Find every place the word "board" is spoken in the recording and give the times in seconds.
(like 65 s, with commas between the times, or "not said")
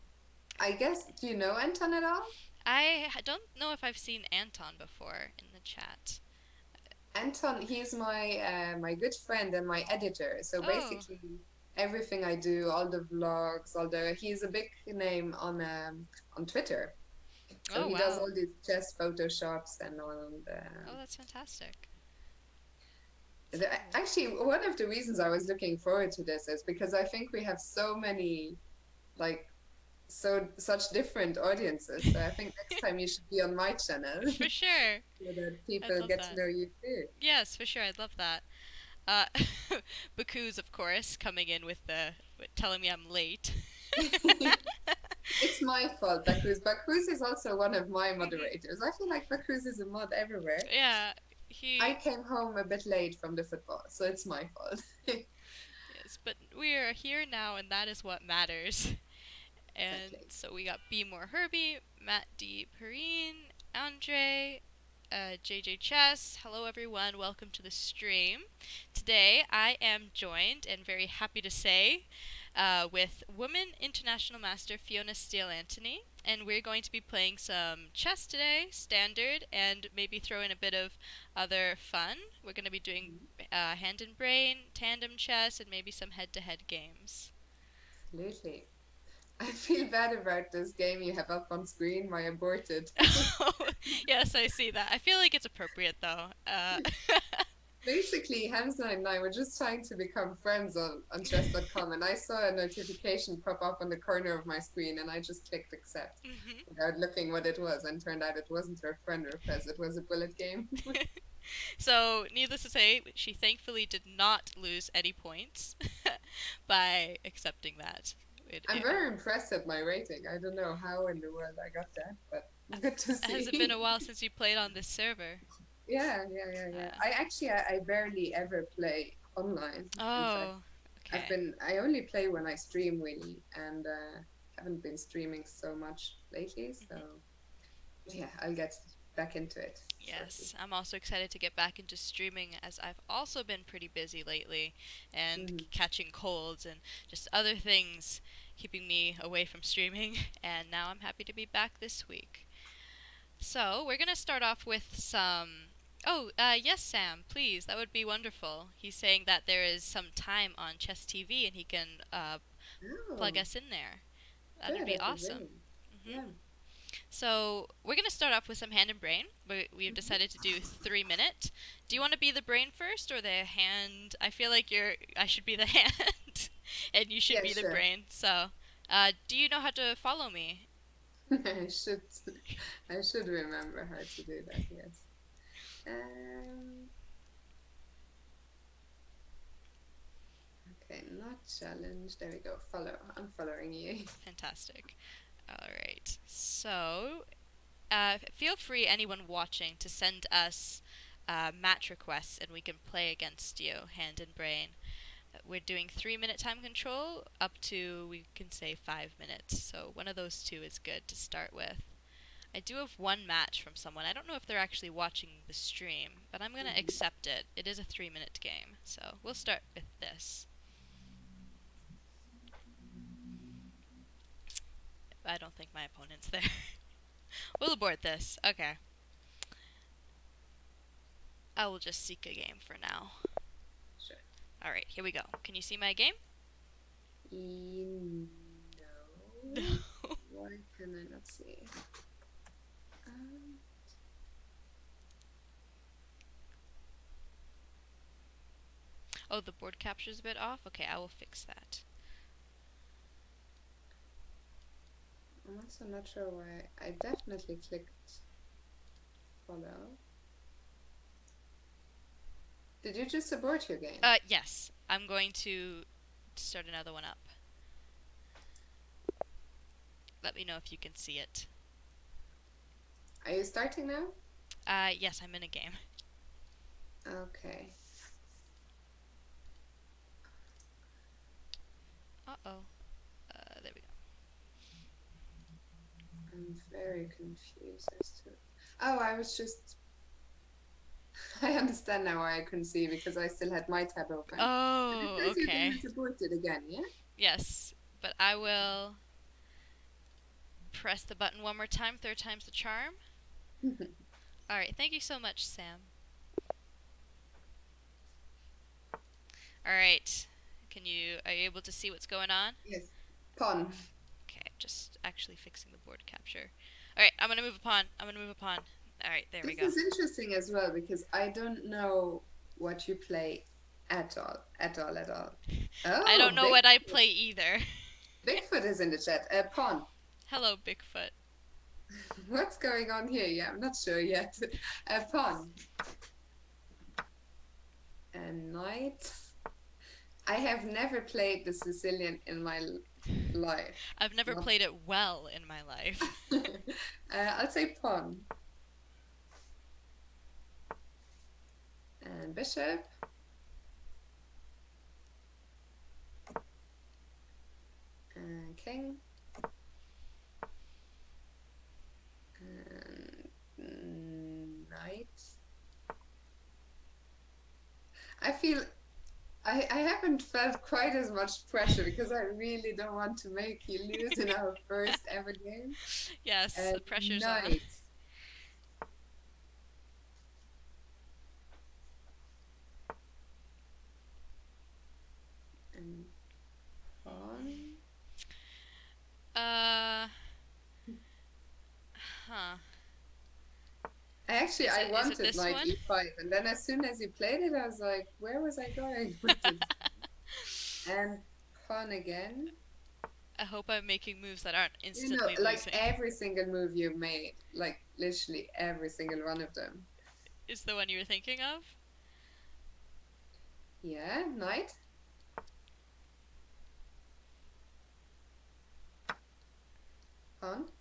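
249 s, 315 s.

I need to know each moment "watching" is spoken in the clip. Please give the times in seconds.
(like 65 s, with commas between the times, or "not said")
199 s, 214 s.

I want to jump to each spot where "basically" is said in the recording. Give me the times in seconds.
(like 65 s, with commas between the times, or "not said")
10 s, 97 s.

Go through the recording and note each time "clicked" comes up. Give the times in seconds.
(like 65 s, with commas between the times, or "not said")
105 s, 257 s.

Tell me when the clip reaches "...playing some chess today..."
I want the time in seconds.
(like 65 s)
76 s.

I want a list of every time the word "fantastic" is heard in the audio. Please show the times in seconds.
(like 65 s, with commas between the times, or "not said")
21 s, 194 s.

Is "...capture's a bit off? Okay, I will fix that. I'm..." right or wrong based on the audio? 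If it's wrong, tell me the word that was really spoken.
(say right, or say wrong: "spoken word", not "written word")
right.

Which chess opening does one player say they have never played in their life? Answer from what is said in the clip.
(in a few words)
The Sicilian.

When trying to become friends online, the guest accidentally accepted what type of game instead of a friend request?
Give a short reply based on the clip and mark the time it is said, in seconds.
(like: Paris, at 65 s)
A bullet game, at 109 s.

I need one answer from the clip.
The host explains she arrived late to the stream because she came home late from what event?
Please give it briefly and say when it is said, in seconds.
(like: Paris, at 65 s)
The football, at 51 s.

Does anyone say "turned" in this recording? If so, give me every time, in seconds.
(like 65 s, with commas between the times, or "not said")
108 s.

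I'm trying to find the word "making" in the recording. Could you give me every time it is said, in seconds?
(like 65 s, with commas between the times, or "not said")
403 s.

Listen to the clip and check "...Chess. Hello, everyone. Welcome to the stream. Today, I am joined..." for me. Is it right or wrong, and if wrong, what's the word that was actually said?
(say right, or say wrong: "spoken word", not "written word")
right.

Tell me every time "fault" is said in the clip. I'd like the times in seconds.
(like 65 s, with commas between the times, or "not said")
45 s, 54 s.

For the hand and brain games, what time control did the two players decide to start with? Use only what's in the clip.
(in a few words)
3 minutes.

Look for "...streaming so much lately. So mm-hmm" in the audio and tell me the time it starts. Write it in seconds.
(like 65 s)
134 s.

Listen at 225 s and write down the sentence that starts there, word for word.
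I don't think my opponent's there.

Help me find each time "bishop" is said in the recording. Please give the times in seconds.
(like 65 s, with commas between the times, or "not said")
352 s.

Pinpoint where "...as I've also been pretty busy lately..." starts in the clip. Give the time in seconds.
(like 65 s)
142 s.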